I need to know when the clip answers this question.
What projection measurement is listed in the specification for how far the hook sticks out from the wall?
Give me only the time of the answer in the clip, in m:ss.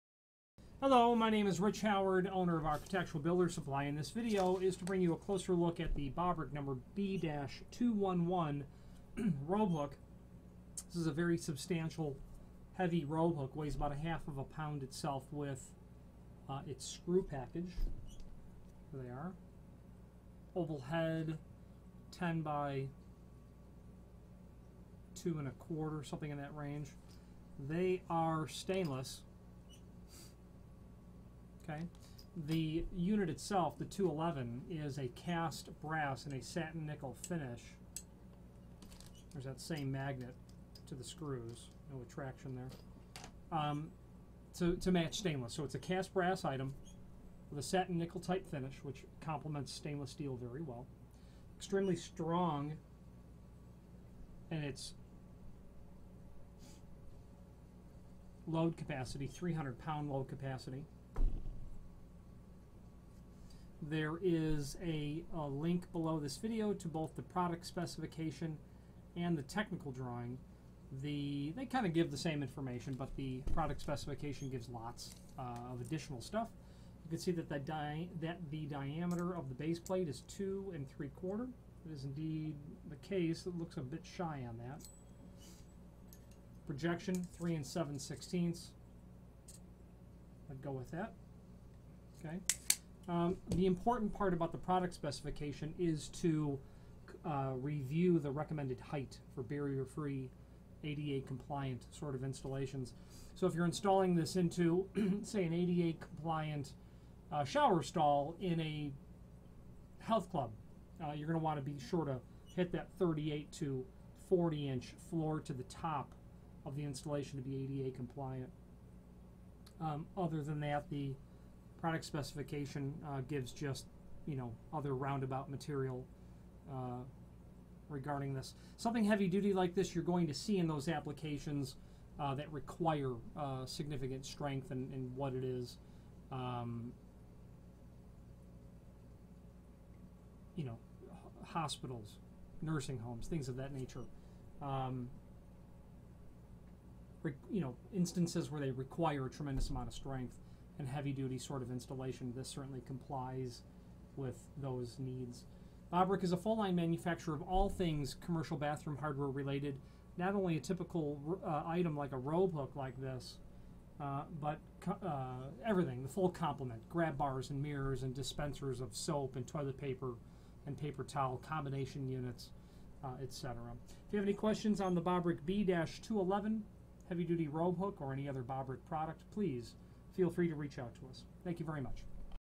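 1:27.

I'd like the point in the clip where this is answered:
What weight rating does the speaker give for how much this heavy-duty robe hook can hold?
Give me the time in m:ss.
0:59.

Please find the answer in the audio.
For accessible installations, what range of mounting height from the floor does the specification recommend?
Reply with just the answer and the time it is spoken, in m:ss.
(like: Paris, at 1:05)
38 to 40 inches, at 1:52.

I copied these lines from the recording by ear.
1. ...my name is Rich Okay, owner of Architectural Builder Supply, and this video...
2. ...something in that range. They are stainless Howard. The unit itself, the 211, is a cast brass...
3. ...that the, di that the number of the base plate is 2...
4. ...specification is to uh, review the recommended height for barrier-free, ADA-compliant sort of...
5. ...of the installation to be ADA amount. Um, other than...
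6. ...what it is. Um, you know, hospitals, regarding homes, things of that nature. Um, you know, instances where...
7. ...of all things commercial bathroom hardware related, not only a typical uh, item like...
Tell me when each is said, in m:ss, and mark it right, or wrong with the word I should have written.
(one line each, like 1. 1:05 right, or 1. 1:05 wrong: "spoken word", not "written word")
1. 0:01 wrong: "Howard", not "Okay"
2. 0:26 wrong: "Okay", not "Howard"
3. 1:17 wrong: "diameter", not "number"
4. 1:34 right
5. 1:56 wrong: "compliant", not "amount"
6. 2:15 wrong: "nursing", not "regarding"
7. 2:37 right.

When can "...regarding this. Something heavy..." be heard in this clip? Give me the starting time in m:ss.
2:07.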